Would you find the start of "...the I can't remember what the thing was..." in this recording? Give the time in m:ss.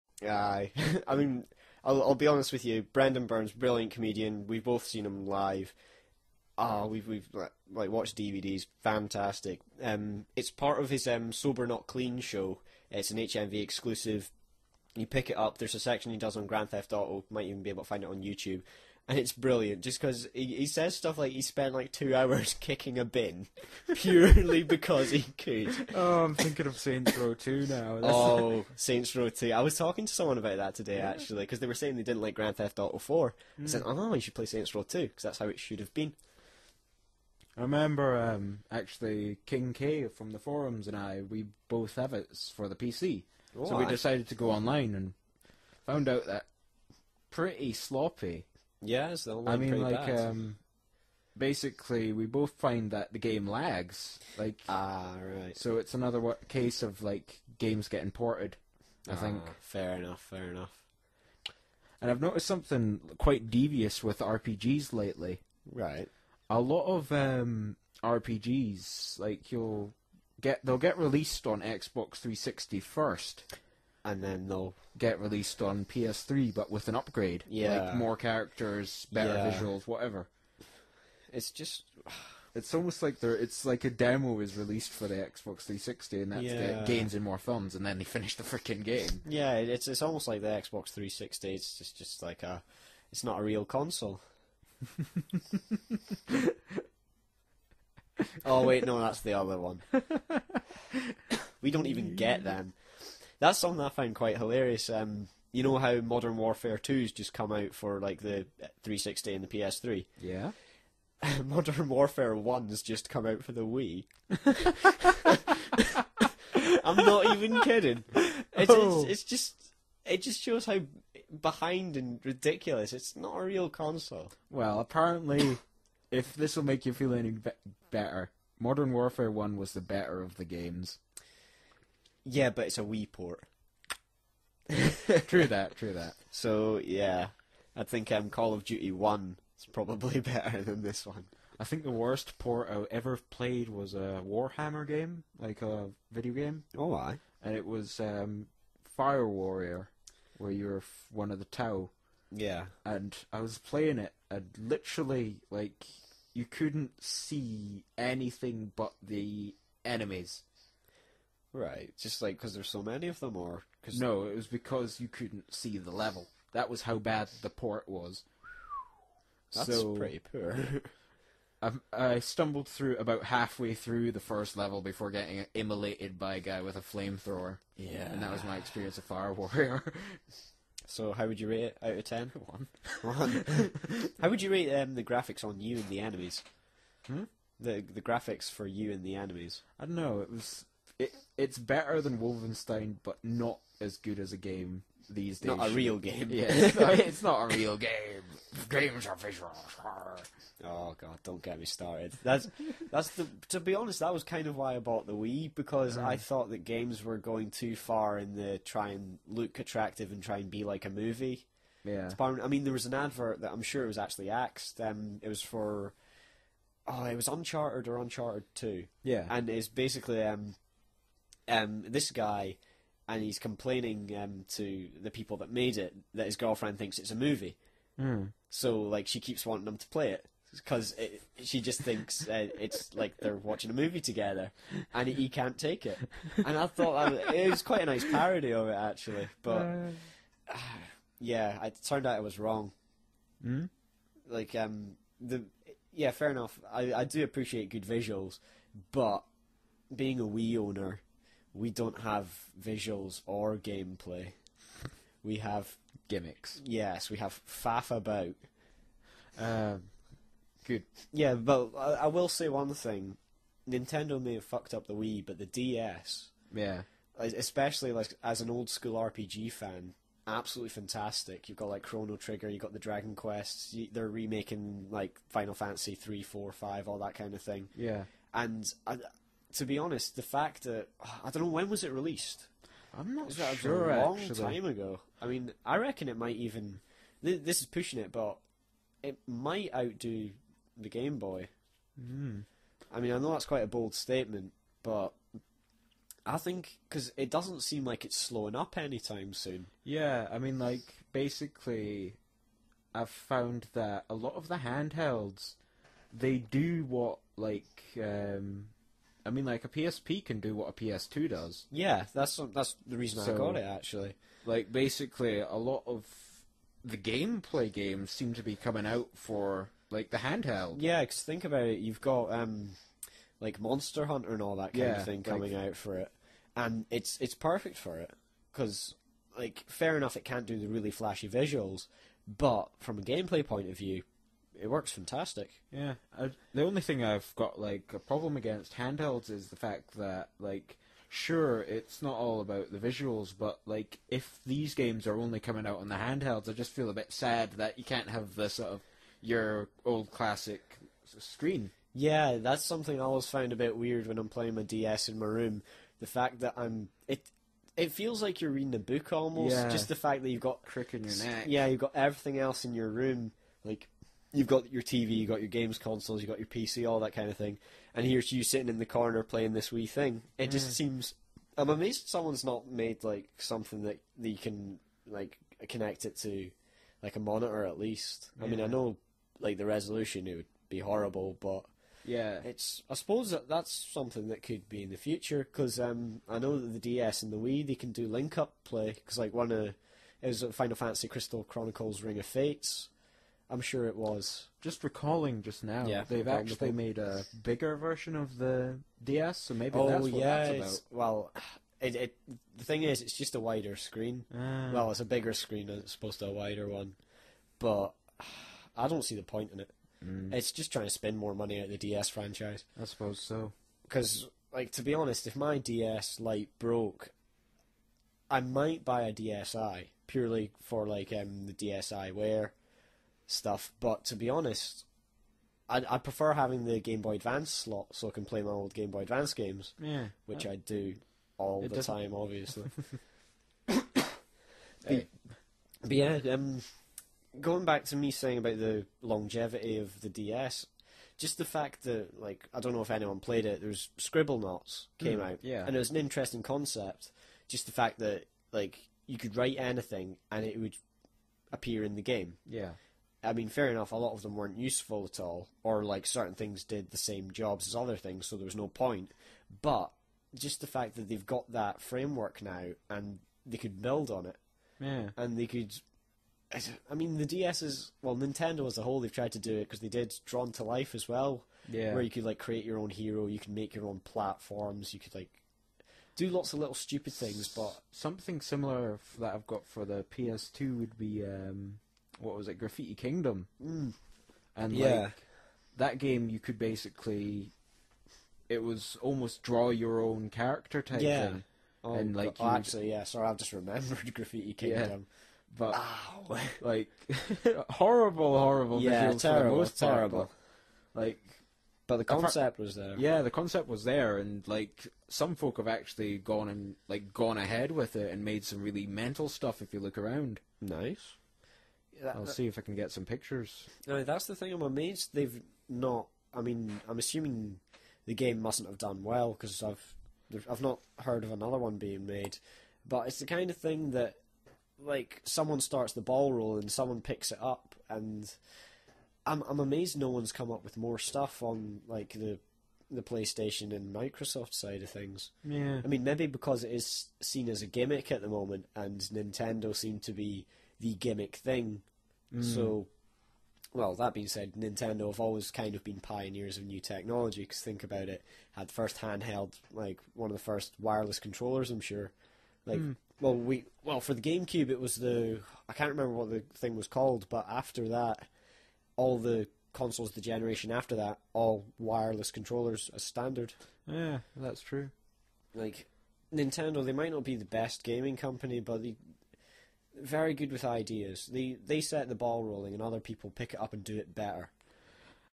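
9:14.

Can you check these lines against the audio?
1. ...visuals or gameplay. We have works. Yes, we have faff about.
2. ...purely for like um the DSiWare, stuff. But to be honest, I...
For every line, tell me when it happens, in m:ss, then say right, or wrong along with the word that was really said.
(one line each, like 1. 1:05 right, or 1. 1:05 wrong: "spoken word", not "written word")
1. 4:12 wrong: "gimmicks", not "works"
2. 7:00 right.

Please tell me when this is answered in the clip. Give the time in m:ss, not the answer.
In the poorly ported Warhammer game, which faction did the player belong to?
2:31.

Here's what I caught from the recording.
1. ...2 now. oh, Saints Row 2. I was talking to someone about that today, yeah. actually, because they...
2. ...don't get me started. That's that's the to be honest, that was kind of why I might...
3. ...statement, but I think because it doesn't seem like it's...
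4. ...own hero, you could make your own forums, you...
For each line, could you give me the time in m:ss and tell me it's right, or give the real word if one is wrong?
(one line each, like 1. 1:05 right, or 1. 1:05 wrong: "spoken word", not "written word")
1. 0:27 right
2. 3:21 wrong: "bought", not "might"
3. 4:53 right
4. 7:52 wrong: "platforms", not "forums".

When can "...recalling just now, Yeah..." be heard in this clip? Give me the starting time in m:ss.
6:34.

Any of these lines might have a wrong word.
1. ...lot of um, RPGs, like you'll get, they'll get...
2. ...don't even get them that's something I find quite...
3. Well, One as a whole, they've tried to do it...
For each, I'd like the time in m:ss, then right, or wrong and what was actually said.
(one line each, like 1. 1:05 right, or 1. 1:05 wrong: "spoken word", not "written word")
1. 1:06 right
2. 1:41 right
3. 7:48 wrong: "Nintendo", not "One".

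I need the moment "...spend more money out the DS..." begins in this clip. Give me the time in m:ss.
6:50.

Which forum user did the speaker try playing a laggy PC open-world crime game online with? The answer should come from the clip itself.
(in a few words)
King K.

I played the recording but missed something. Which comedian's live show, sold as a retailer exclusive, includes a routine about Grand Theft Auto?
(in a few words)
Brendon Burns.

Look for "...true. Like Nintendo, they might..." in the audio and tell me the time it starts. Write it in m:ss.
9:24.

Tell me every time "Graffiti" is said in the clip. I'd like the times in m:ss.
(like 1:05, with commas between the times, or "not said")
8:02, 8:14.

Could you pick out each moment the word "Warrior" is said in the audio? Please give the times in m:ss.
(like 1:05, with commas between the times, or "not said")
2:29, 2:59.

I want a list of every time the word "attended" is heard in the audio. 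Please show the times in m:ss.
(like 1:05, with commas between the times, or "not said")
not said.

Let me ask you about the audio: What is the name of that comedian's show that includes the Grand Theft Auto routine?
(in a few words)
Sober not clean.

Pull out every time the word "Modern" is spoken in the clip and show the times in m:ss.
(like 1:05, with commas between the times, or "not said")
1:45, 1:51, 2:08.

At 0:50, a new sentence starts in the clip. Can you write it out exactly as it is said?
um, basically, we both find that the game lags.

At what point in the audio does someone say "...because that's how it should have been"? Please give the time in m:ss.
0:35.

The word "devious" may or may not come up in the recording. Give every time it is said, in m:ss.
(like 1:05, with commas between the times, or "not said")
1:03.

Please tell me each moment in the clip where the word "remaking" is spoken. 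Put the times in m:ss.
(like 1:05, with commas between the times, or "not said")
4:34.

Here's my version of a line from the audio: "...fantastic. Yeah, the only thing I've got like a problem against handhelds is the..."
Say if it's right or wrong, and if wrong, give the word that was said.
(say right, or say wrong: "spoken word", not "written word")
right.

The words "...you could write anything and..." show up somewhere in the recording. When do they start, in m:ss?
7:29.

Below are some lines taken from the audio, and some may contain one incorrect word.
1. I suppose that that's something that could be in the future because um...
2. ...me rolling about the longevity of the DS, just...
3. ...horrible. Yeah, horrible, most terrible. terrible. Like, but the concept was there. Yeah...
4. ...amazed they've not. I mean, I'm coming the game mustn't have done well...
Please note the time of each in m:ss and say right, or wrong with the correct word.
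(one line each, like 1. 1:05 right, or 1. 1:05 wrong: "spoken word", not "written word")
1. 6:22 right
2. 7:17 wrong: "saying", not "rolling"
3. 8:18 wrong: "terrible", not "horrible"
4. 8:34 wrong: "assuming", not "coming".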